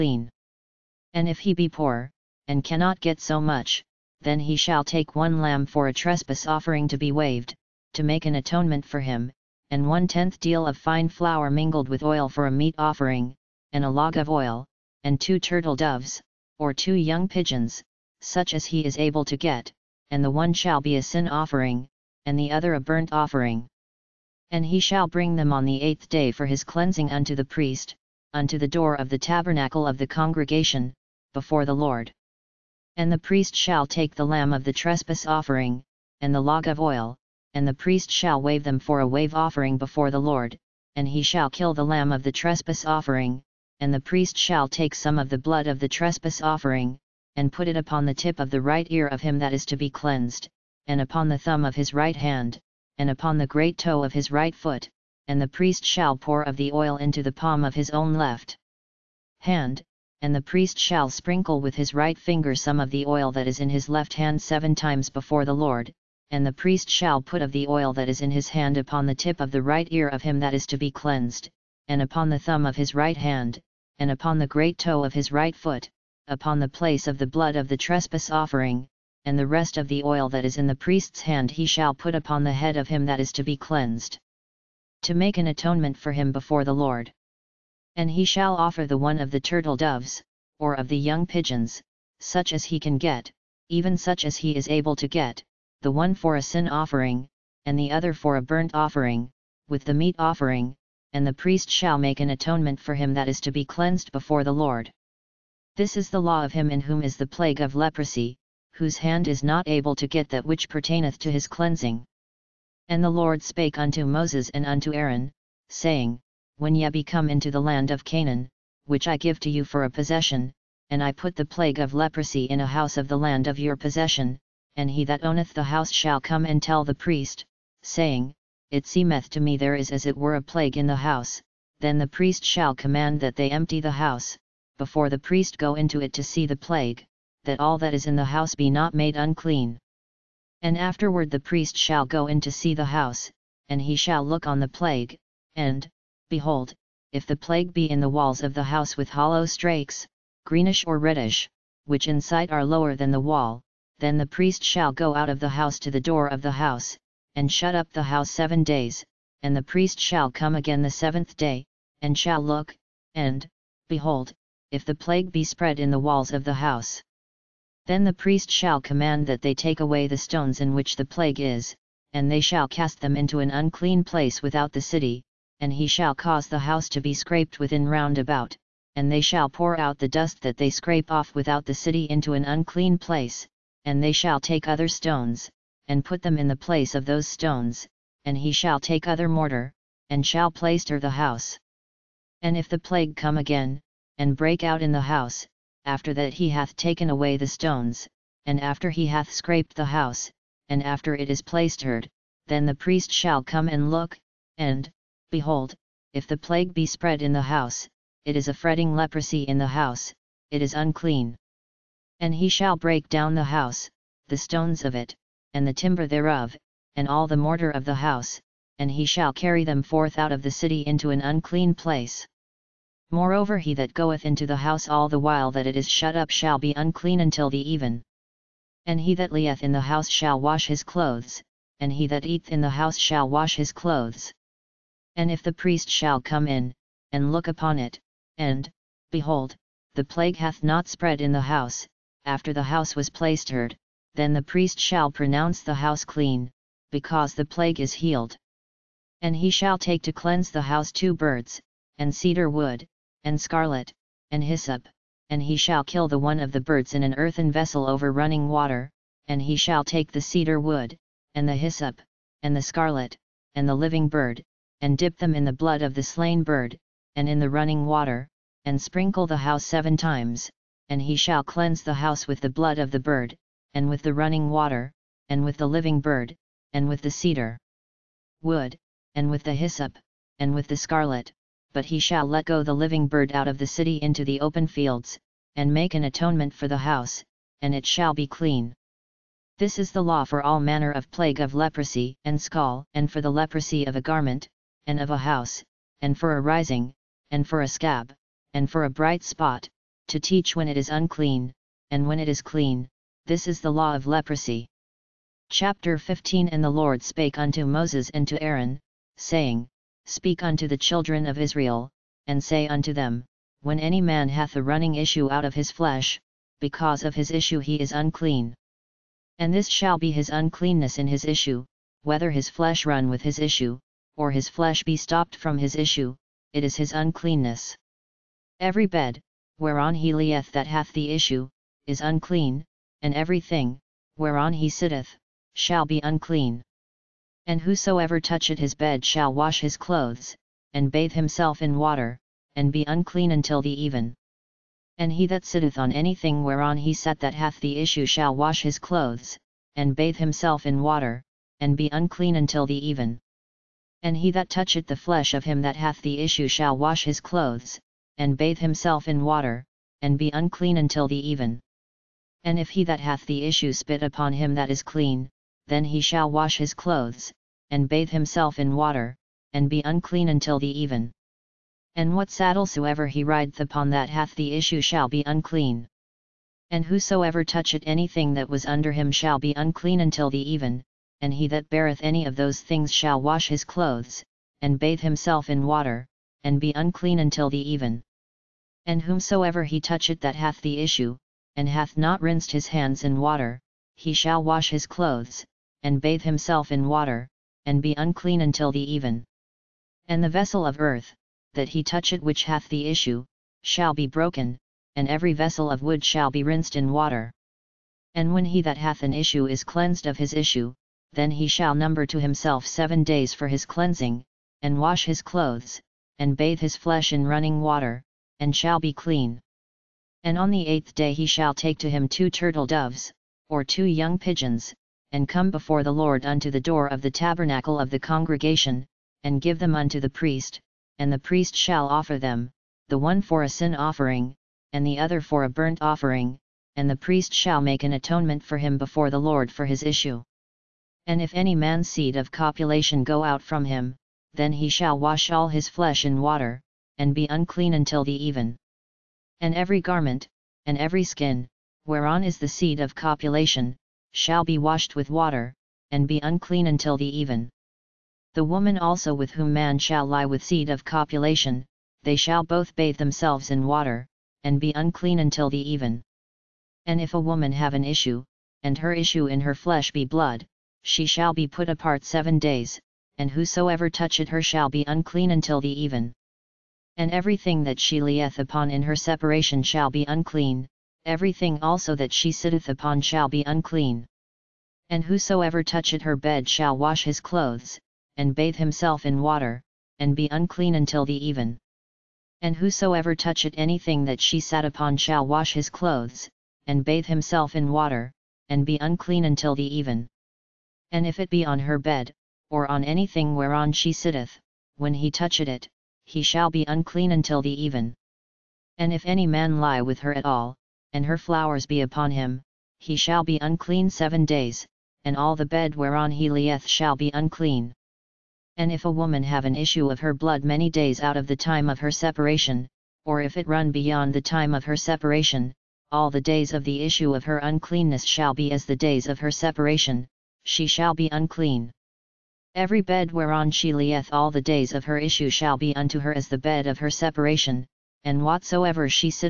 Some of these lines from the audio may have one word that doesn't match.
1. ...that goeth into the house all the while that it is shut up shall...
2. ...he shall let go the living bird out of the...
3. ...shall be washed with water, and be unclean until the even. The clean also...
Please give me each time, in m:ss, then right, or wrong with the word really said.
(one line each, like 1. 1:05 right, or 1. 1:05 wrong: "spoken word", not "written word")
1. 3:43 right
2. 4:41 right
3. 7:34 wrong: "woman", not "clean".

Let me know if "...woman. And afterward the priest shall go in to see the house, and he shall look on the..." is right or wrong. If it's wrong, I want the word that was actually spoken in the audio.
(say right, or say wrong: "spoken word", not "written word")
wrong: "unclean", not "woman".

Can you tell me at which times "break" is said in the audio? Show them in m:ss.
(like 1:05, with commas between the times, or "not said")
3:14, 3:32.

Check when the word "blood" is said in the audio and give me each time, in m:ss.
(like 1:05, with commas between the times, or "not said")
0:45, 1:17, 4:25, 4:32, 7:50, 8:40.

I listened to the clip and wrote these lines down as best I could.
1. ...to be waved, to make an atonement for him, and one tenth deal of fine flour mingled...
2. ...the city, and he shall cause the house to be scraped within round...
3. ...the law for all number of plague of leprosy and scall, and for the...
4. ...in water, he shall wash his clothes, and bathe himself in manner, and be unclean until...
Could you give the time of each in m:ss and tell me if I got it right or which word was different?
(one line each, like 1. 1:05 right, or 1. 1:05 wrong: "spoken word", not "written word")
1. 0:06 right
2. 2:54 right
3. 4:49 wrong: "manner", not "number"
4. 6:33 wrong: "water", not "manner".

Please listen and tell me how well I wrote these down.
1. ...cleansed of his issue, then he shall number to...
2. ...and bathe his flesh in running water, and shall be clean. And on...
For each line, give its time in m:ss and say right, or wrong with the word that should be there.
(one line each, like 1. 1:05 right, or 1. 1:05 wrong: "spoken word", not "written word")
1. 6:49 right
2. 6:56 right.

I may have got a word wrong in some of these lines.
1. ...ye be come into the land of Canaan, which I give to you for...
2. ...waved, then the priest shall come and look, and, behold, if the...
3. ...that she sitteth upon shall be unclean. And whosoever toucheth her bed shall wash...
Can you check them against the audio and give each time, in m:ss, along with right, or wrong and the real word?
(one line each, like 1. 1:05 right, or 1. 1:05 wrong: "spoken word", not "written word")
1. 1:56 right
2. 3:21 wrong: "plastered", not "waved"
3. 8:01 right.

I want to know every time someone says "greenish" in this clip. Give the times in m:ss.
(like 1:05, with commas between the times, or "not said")
2:30.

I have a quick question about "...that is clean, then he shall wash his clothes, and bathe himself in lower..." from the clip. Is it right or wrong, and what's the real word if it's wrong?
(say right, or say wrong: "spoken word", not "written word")
wrong: "water", not "lower".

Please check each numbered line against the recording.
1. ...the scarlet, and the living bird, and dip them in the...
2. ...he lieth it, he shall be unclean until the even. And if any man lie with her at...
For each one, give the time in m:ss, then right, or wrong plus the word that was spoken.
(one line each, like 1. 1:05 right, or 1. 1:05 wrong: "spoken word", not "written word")
1. 4:22 right
2. 8:24 wrong: "toucheth", not "lieth".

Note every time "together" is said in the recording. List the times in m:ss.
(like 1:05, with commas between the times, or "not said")
not said.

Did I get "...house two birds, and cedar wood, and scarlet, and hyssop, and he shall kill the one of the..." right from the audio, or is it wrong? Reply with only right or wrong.
right.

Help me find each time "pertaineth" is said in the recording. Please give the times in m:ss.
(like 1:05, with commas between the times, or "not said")
1:50.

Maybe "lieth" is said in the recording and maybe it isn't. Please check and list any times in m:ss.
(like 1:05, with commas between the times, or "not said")
3:49, 5:30, 7:58, 8:36, 8:53.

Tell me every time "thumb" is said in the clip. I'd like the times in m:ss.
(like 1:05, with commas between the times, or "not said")
0:51, 1:12.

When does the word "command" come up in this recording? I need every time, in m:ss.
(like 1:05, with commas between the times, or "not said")
2:12, 2:48.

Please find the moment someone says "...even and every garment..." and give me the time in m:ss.
7:28.